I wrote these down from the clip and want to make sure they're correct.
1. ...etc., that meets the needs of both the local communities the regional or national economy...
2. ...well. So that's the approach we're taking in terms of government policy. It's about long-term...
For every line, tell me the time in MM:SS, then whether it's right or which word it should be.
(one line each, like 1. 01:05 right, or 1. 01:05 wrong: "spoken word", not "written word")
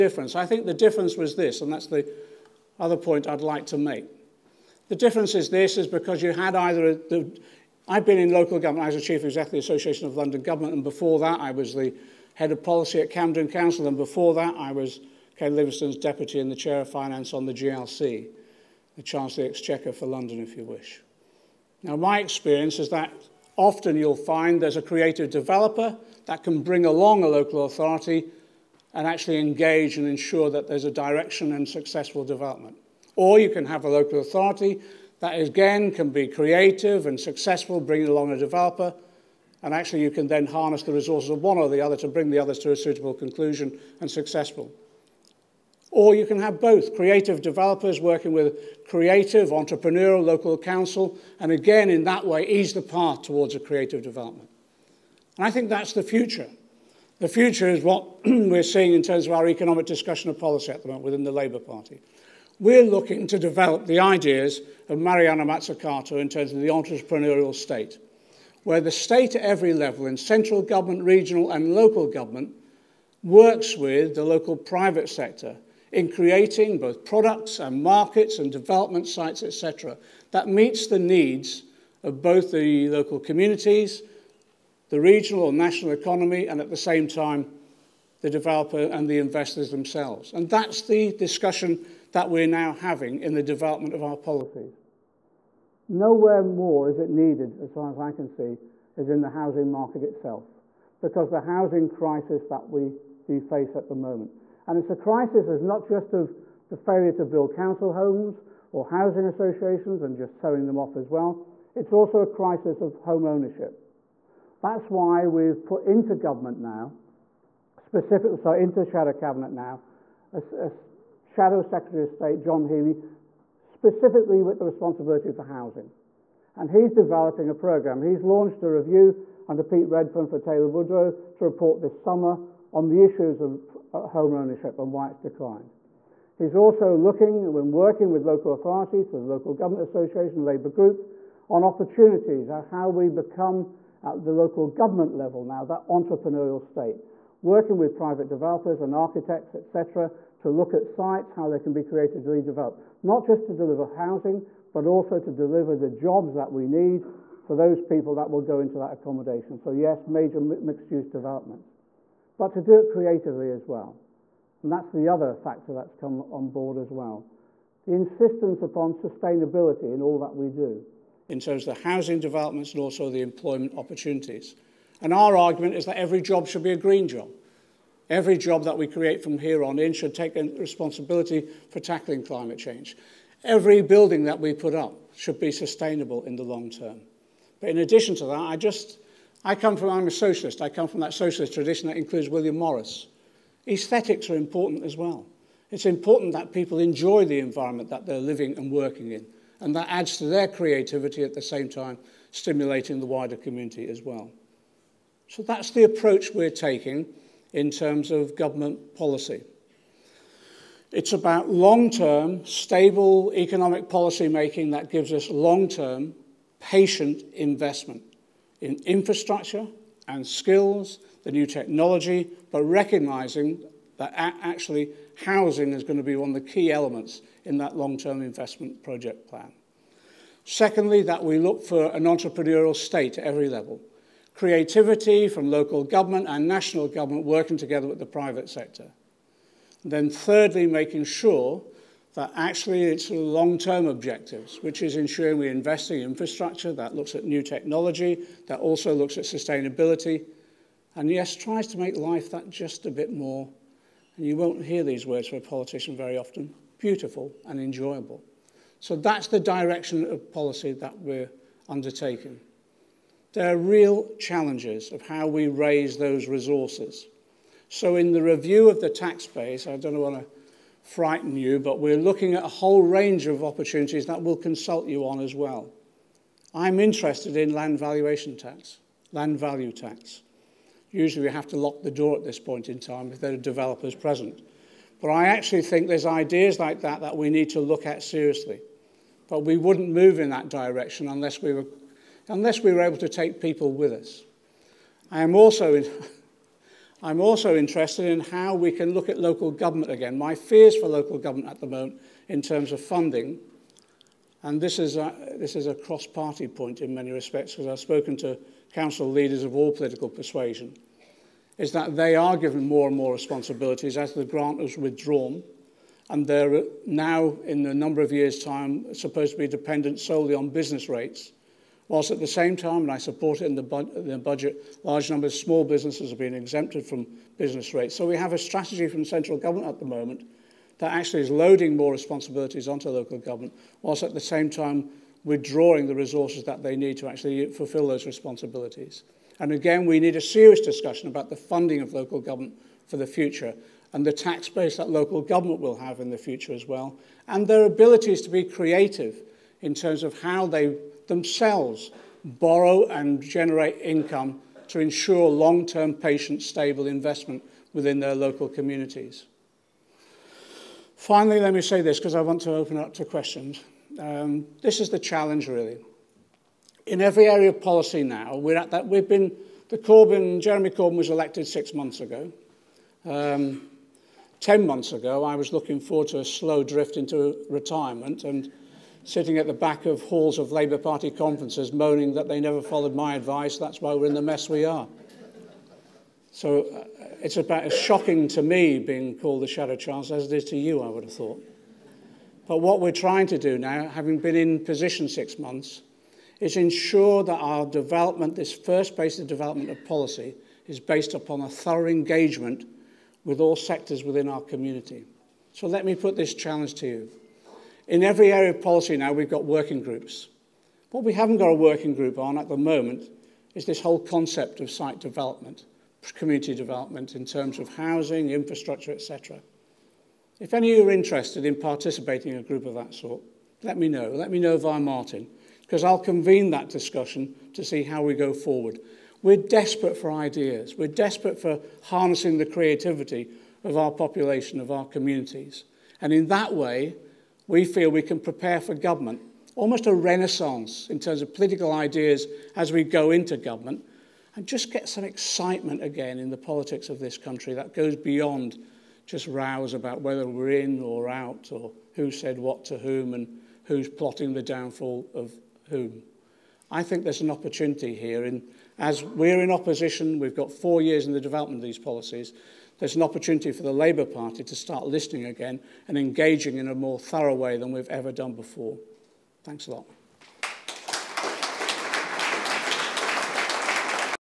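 1. 01:19 right
2. 03:24 right.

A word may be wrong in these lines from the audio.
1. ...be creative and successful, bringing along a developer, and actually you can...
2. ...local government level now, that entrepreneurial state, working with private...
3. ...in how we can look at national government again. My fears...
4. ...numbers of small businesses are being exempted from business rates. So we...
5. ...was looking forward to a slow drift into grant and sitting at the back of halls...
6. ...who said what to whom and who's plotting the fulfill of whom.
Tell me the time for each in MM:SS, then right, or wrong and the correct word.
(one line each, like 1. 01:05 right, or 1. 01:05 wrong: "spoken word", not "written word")
1. 00:36 right
2. 02:24 right
3. 04:58 wrong: "local", not "national"
4. 05:25 right
5. 06:15 wrong: "retirement", not "grant"
6. 07:31 wrong: "downfall", not "fulfill".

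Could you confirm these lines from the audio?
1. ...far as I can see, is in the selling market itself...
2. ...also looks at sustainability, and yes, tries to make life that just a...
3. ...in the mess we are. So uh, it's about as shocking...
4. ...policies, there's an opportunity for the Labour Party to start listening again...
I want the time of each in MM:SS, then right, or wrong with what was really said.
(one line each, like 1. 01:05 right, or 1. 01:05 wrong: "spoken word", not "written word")
1. 01:37 wrong: "housing", not "selling"
2. 04:08 right
3. 06:24 right
4. 07:41 right.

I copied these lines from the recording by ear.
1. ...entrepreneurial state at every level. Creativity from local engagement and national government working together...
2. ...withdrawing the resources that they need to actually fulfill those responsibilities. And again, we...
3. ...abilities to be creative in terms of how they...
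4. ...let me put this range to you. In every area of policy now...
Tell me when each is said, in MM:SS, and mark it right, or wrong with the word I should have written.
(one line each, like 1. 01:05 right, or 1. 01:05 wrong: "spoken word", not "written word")
1. 03:52 wrong: "government", not "engagement"
2. 05:35 right
3. 05:47 right
4. 06:45 wrong: "challenge", not "range".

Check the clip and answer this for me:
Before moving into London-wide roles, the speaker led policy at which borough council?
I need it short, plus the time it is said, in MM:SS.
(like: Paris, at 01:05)
Camden Council, at 00:13.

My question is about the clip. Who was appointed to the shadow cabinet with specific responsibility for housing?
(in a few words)
John Healey.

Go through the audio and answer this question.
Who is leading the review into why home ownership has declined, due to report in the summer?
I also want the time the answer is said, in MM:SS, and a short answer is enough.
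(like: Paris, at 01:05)
Pete Redfern, at 02:09.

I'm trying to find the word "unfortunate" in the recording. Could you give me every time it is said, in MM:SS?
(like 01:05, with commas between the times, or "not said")
not said.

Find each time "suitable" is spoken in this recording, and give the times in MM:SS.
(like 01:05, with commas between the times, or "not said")
00:42.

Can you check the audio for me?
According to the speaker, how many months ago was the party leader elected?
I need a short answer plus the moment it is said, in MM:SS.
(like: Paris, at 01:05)
6, at 06:11.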